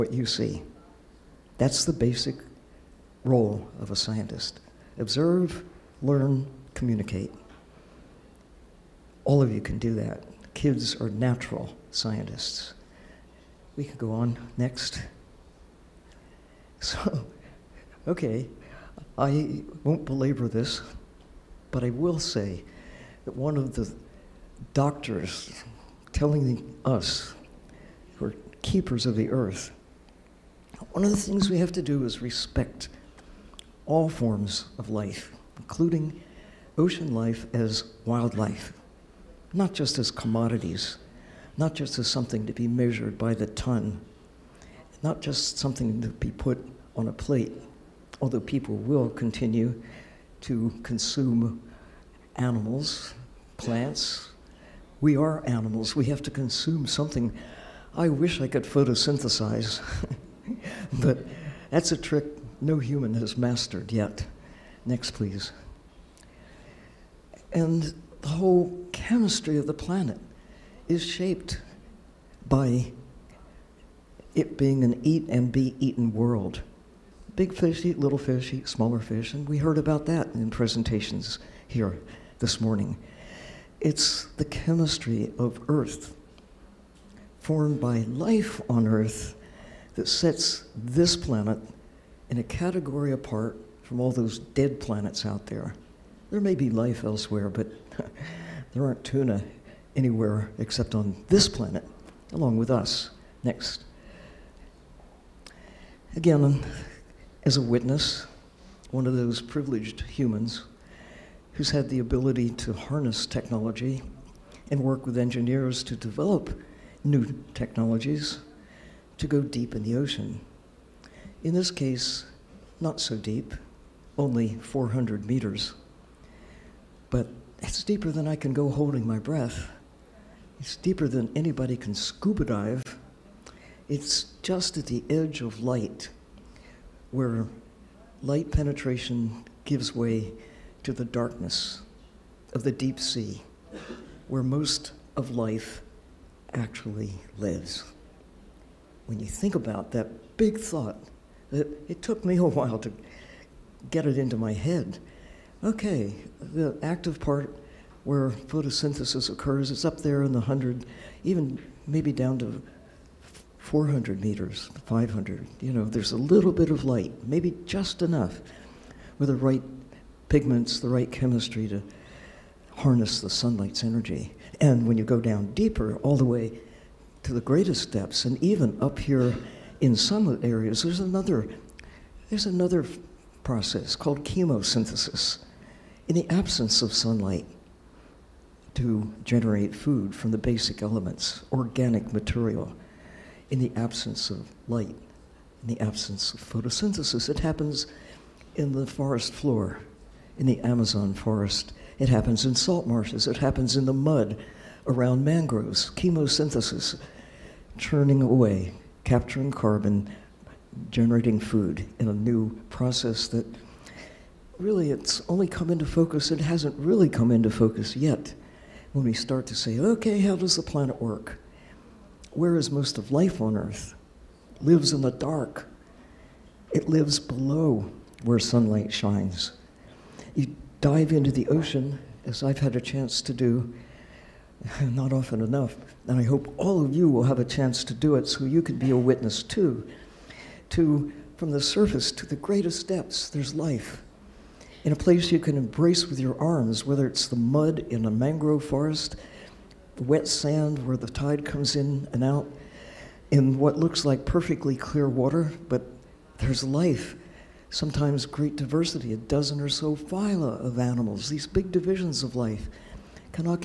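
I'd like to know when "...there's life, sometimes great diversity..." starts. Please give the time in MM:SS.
04:16.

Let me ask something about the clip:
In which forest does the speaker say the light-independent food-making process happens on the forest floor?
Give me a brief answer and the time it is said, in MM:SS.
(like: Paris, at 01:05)
Amazon, at 03:20.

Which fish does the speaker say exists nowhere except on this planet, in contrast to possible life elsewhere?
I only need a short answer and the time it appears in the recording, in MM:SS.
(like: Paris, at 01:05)
Tuna, at 01:39.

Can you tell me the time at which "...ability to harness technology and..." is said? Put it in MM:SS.
01:51.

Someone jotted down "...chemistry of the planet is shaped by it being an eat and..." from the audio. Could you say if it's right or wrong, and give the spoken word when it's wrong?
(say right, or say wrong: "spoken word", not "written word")
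right.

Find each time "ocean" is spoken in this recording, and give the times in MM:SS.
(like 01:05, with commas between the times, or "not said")
00:36, 01:59, 03:51.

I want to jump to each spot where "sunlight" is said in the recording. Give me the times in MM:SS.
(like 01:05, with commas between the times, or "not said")
02:53, 03:06, 03:48.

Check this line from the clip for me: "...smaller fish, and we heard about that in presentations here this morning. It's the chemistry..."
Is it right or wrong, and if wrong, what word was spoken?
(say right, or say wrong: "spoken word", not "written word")
right.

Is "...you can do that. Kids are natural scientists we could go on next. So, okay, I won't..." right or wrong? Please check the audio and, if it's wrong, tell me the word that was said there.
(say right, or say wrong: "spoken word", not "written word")
right.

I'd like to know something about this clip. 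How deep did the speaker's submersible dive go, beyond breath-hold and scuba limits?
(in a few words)
400 meters.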